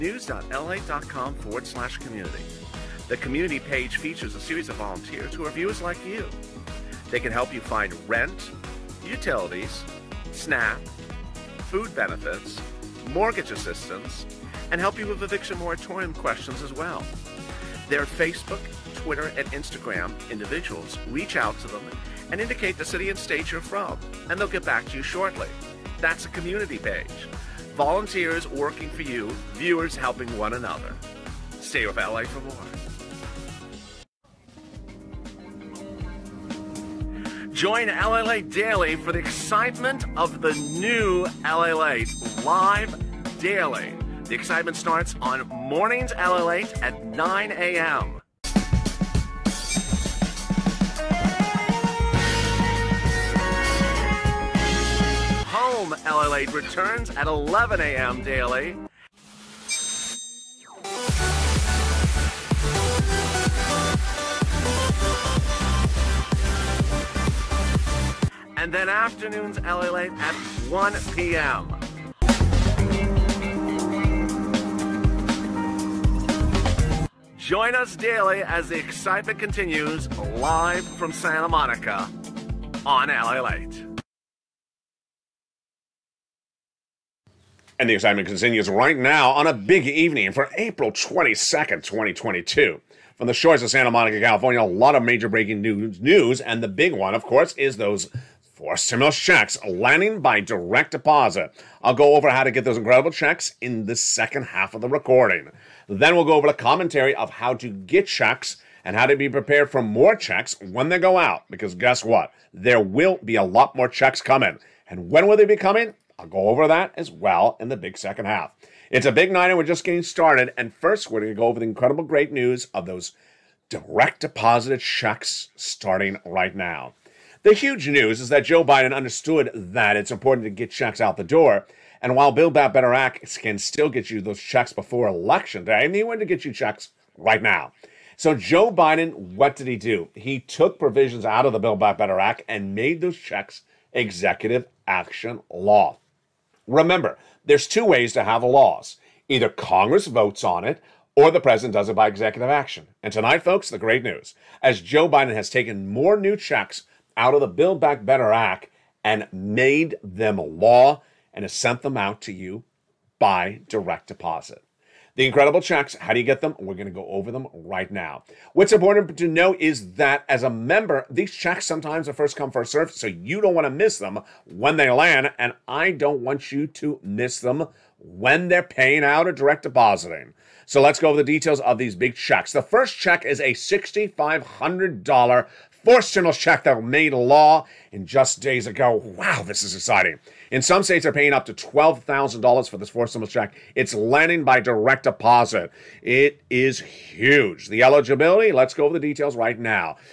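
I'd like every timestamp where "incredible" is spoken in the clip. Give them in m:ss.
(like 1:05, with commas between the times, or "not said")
1:42, 2:01, 2:45.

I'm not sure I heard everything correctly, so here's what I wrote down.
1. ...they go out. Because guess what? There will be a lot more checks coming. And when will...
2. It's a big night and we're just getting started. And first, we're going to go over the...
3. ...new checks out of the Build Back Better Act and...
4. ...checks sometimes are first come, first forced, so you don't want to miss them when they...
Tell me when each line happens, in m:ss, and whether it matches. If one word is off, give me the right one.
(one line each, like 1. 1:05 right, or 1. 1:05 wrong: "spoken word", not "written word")
1. 1:50 right
2. 1:58 right
3. 2:36 right
4. 2:51 wrong: "served", not "forced".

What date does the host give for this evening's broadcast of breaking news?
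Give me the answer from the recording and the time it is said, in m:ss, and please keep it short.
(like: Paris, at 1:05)
April 22, 2022, at 1:30.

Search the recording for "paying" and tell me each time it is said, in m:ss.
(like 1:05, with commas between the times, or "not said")
2:58, 3:11.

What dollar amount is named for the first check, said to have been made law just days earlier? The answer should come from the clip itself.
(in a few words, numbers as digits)
$6,500.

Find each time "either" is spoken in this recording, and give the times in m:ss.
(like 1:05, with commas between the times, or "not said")
2:29.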